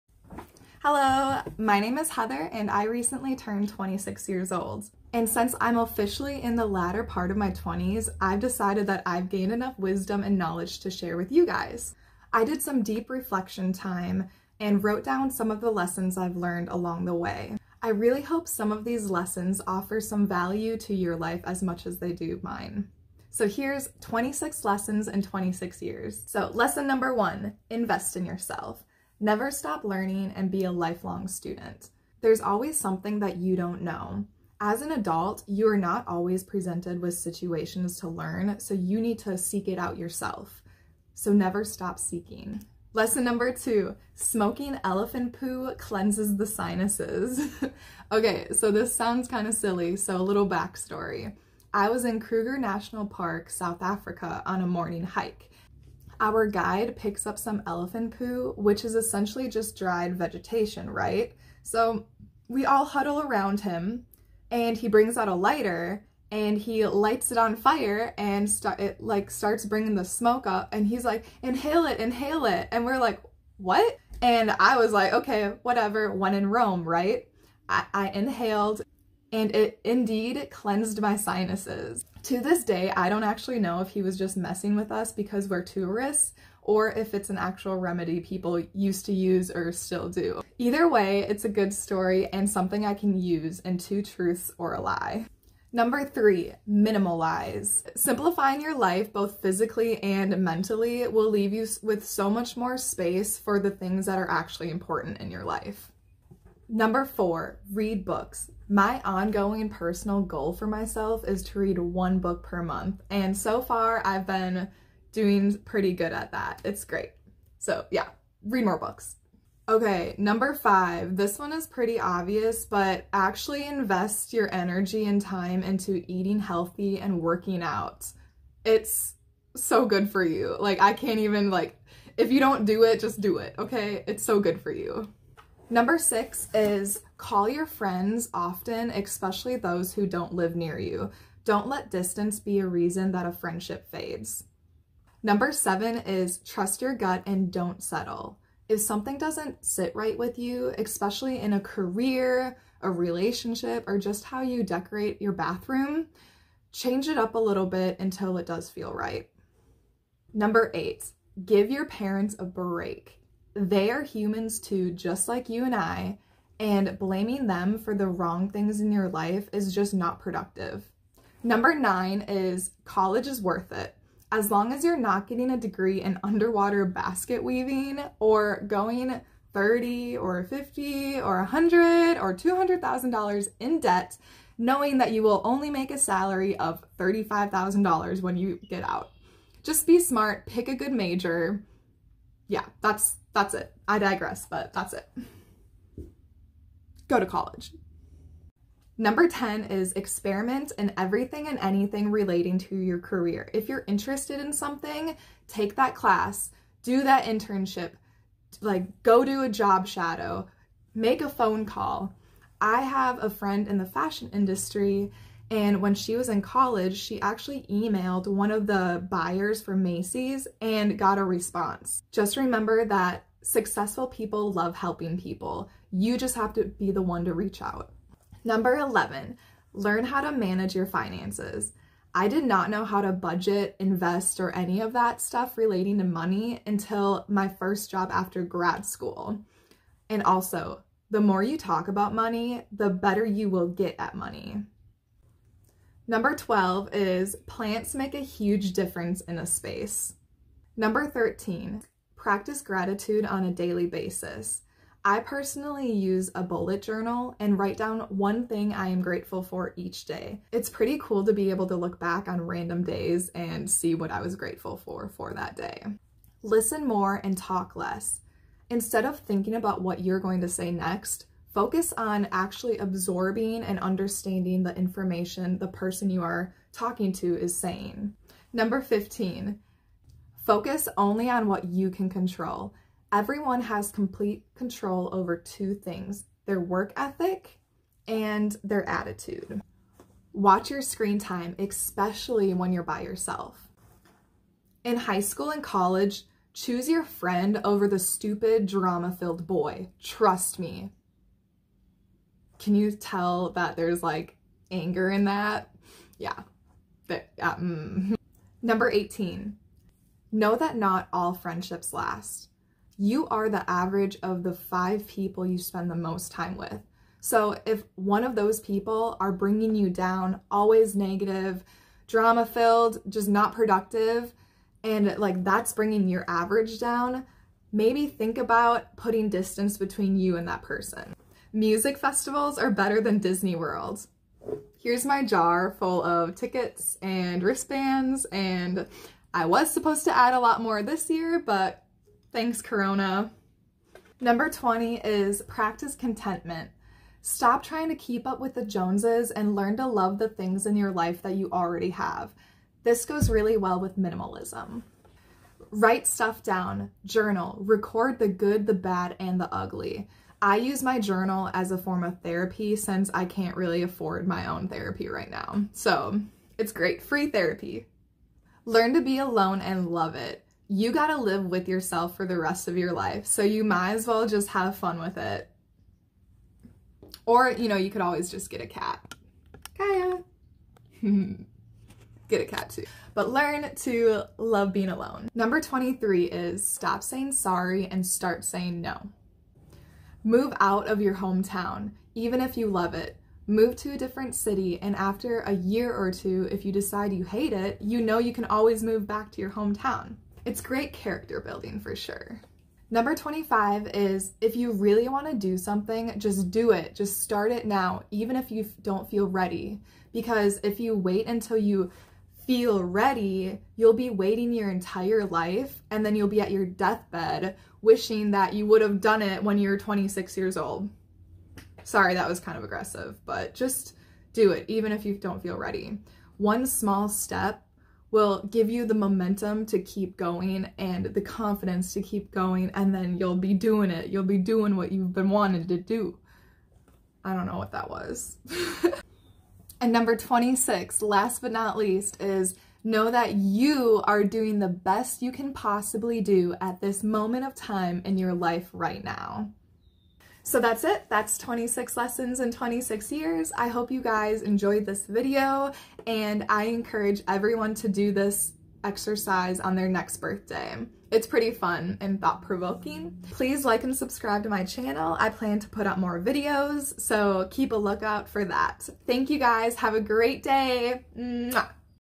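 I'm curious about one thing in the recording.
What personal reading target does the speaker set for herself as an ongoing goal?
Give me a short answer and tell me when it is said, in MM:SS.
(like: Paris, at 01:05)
One book per month, at 01:51.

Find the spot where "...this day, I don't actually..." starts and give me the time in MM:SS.
01:22.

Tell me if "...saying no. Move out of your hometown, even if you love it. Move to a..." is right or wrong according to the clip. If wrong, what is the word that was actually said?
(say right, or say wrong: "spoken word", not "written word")
right.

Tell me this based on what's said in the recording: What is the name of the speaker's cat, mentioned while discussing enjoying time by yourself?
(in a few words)
Kaya.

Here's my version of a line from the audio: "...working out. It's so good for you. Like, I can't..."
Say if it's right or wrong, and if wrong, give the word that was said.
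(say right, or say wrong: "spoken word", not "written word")
right.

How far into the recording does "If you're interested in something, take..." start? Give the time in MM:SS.
03:23.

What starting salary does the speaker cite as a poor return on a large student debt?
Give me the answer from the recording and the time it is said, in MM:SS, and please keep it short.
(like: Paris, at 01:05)
$35,000, at 03:06.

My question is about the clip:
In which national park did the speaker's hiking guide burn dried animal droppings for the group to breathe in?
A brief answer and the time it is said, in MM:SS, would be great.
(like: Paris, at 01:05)
Kruger National Park, at 00:52.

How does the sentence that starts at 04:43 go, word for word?
Everyone has complete control over two things, their work ethic and their attitude.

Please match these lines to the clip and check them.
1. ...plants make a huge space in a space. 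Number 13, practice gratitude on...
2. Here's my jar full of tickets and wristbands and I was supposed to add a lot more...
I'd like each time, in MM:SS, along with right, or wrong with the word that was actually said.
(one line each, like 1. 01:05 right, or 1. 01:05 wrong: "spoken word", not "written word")
1. 04:07 wrong: "difference", not "space"
2. 05:34 right.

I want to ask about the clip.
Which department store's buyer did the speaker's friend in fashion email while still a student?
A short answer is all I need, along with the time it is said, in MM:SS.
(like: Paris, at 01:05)
Macy's, at 03:39.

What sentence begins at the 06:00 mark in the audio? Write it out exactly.
I use my journal as a form of therapy since I can't really afford my own therapy right now.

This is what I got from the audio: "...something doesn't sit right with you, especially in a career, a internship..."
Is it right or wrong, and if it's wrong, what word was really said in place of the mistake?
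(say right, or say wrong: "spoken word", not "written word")
wrong: "relationship", not "internship".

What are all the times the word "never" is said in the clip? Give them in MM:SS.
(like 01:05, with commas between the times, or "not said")
00:29, 00:41.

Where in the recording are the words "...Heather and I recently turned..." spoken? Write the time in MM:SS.
00:02.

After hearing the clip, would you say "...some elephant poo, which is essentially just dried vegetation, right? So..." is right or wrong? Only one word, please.
right.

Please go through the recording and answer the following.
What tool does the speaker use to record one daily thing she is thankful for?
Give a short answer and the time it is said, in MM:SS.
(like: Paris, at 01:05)
A bullet journal, at 04:16.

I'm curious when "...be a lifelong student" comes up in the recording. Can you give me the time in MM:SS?
00:30.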